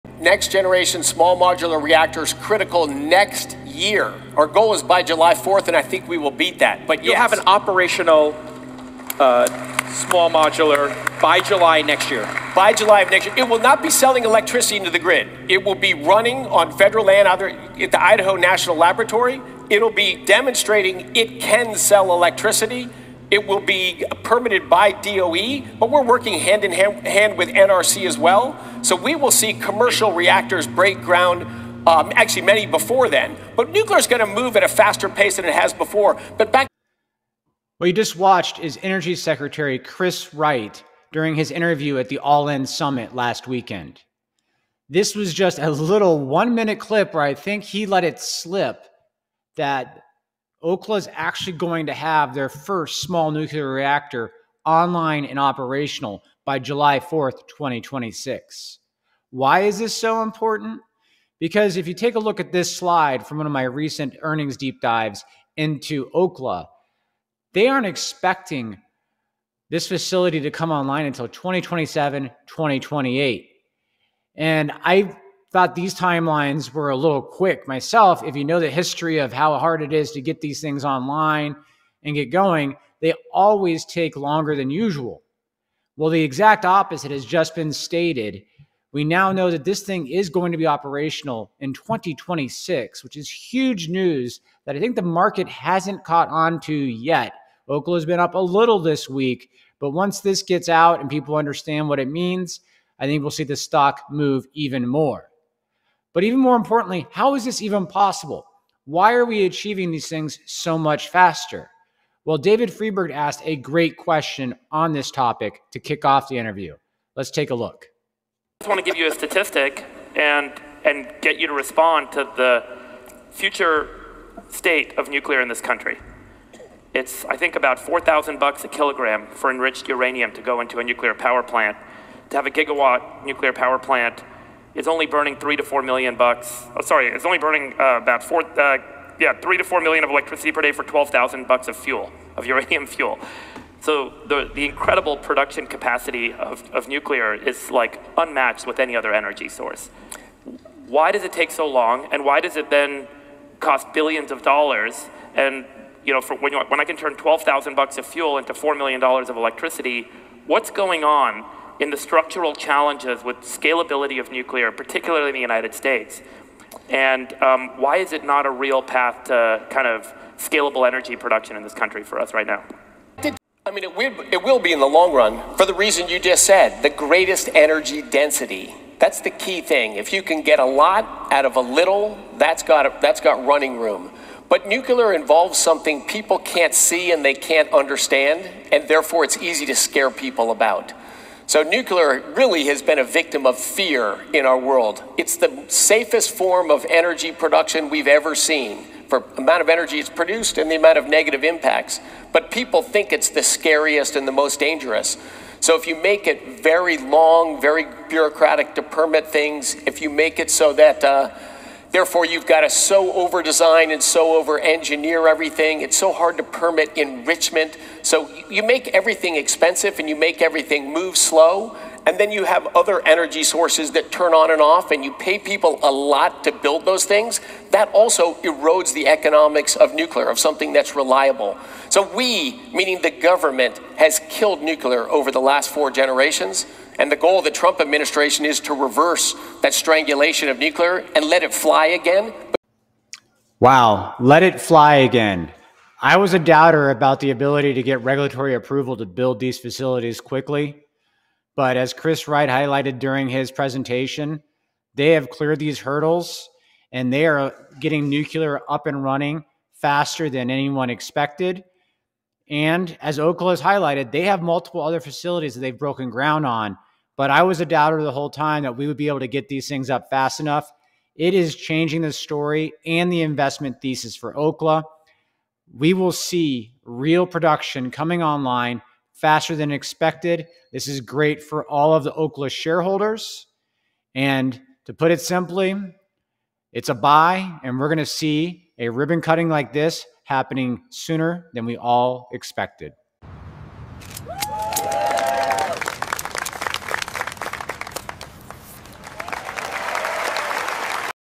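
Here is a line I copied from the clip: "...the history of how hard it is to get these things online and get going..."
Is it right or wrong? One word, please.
right.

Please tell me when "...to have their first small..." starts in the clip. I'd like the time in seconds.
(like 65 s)
51 s.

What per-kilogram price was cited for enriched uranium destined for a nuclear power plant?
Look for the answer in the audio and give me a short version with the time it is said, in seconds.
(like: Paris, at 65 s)
$4,000, at 127 s.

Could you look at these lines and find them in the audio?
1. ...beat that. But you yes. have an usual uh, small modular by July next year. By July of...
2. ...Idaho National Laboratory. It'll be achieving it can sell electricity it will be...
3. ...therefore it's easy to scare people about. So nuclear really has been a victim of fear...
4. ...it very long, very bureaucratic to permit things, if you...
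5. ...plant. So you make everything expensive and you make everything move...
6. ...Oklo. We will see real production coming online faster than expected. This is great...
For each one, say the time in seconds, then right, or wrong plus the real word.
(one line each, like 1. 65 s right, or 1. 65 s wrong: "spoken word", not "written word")
1. 6 s wrong: "operational", not "usual"
2. 18 s wrong: "demonstrating", not "achieving"
3. 188 s right
4. 206 s right
5. 216 s wrong: "enrichment", not "plant"
6. 274 s right.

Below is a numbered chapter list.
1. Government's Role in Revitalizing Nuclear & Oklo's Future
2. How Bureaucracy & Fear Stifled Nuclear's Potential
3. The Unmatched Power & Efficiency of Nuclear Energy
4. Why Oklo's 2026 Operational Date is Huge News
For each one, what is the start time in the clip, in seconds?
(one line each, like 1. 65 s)
1. 290 s
2. 225 s
3. 150 s
4. 75 s.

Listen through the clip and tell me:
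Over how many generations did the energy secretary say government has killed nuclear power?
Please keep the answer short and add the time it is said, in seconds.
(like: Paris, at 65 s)
4, at 235 s.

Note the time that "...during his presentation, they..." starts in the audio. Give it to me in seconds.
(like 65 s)
252 s.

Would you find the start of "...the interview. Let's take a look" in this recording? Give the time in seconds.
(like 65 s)
116 s.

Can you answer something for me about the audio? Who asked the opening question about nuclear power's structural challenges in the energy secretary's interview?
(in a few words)
David Freeberg.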